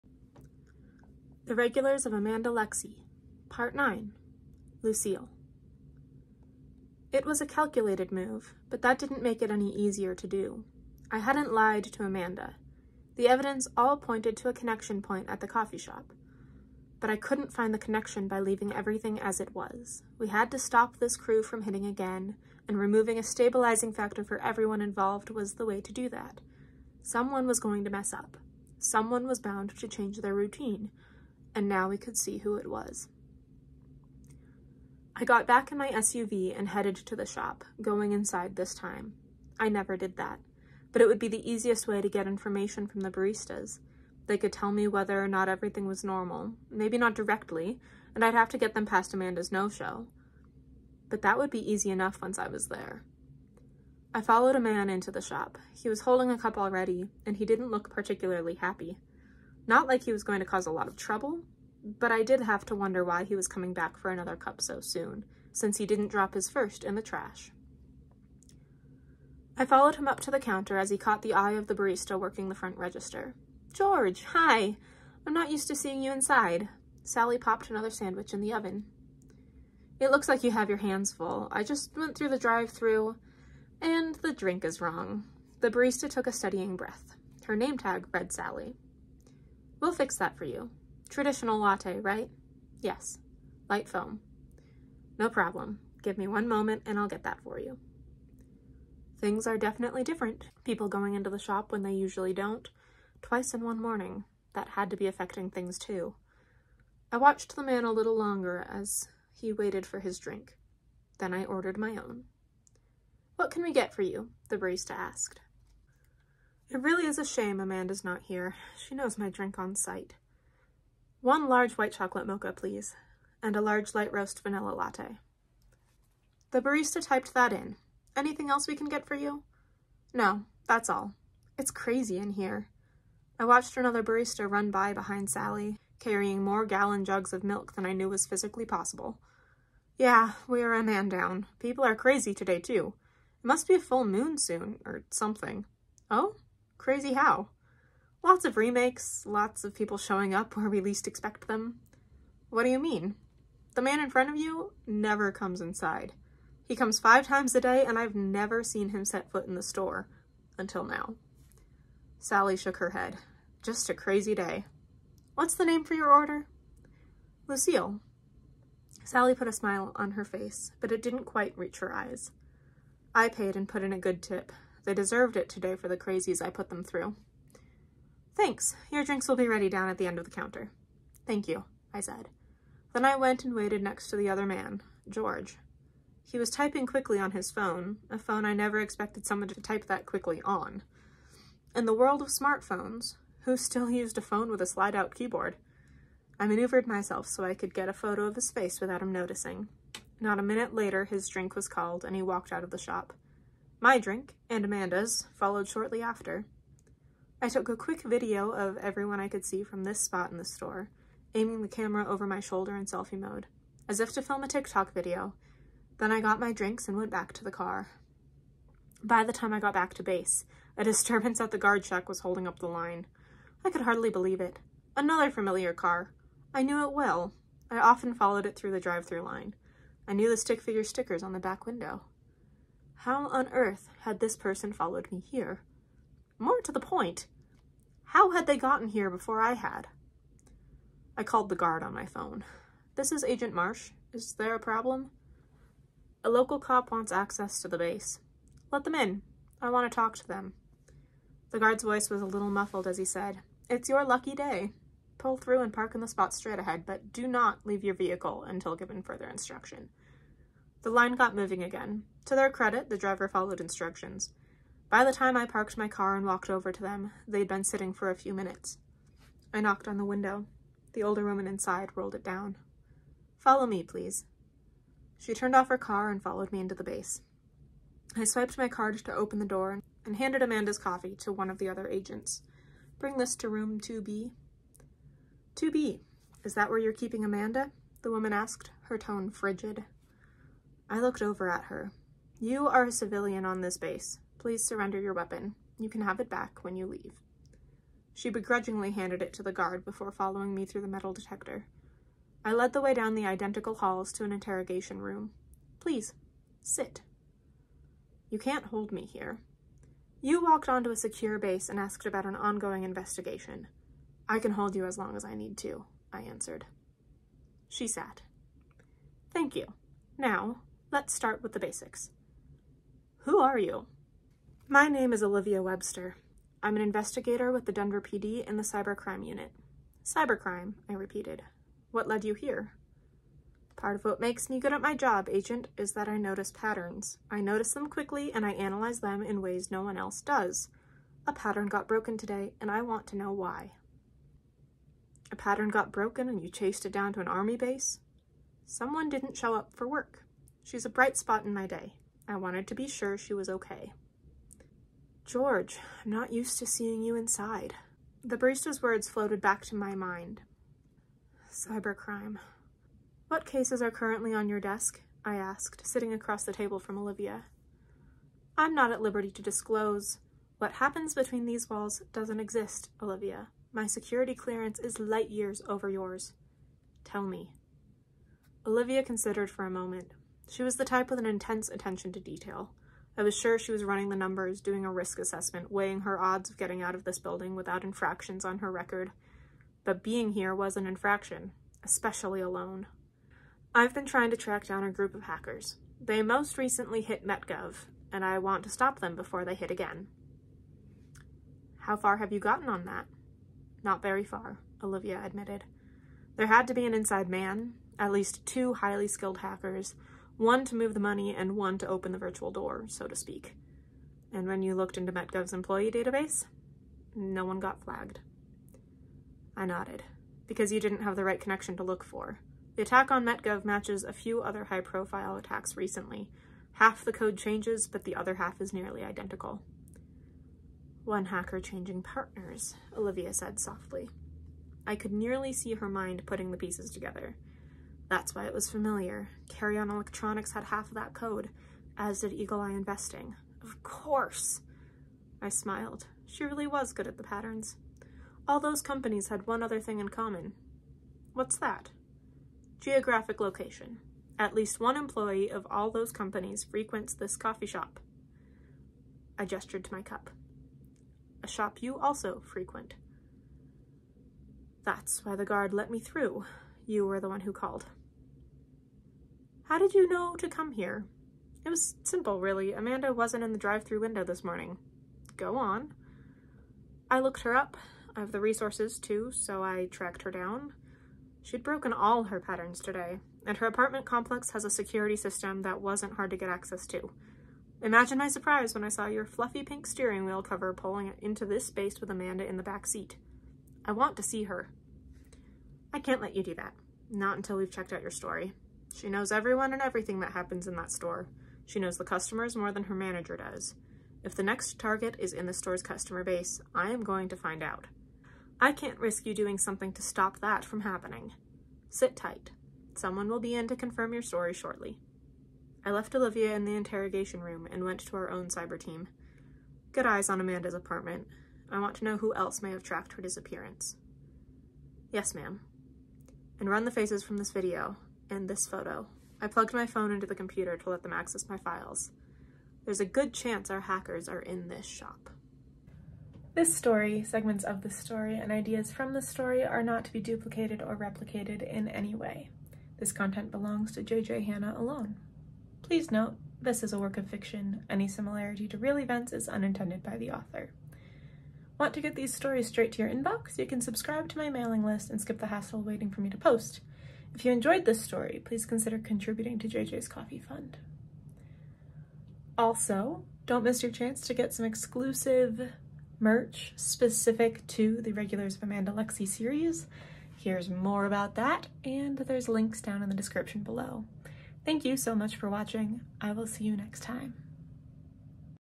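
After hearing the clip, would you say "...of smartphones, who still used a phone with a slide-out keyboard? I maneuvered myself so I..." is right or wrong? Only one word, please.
right.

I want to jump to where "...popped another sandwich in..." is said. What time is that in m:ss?
1:17.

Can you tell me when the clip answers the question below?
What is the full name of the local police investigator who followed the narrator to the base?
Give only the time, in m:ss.
5:25.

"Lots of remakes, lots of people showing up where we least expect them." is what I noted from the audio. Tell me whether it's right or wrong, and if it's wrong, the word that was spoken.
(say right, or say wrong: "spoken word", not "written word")
right.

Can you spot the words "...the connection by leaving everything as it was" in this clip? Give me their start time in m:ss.
0:17.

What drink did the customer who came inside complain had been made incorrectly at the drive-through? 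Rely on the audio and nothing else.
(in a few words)
Traditional latte.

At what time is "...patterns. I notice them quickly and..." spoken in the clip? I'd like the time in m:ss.
5:36.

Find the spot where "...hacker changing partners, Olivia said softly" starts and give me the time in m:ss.
7:11.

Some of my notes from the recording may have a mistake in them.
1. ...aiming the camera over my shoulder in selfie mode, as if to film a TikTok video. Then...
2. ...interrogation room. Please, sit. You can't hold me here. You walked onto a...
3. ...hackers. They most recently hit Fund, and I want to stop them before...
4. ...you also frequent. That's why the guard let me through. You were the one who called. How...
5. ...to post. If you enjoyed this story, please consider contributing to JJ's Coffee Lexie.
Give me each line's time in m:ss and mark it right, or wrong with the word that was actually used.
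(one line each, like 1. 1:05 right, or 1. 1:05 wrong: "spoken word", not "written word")
1. 3:31 right
2. 5:04 right
3. 6:35 wrong: "MetGov", not "Fund"
4. 7:41 right
5. 9:16 wrong: "Fund", not "Lexie".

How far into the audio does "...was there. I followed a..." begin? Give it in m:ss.
0:52.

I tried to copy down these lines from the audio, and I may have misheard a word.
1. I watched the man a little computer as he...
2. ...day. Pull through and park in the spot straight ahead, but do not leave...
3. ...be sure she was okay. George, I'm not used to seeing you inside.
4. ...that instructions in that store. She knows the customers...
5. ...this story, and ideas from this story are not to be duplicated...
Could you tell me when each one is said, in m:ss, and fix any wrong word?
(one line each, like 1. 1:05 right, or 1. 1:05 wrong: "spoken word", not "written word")
1. 1:47 wrong: "longer", not "computer"
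2. 4:14 right
3. 5:52 right
4. 8:20 wrong: "happens", not "instructions"
5. 8:57 right.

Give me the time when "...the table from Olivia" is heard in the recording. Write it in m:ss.
6:06.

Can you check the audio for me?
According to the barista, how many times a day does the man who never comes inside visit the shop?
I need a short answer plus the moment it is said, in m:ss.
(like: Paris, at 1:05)
5, at 2:36.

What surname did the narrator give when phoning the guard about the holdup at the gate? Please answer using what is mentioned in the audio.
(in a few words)
Marsh.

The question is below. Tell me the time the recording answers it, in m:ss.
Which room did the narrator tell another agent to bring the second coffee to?
4:43.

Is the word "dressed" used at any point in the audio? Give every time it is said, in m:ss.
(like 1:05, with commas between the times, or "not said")
not said.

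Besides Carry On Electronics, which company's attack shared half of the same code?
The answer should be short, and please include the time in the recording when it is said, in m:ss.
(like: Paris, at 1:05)
Eagle Eye Investing, at 7:22.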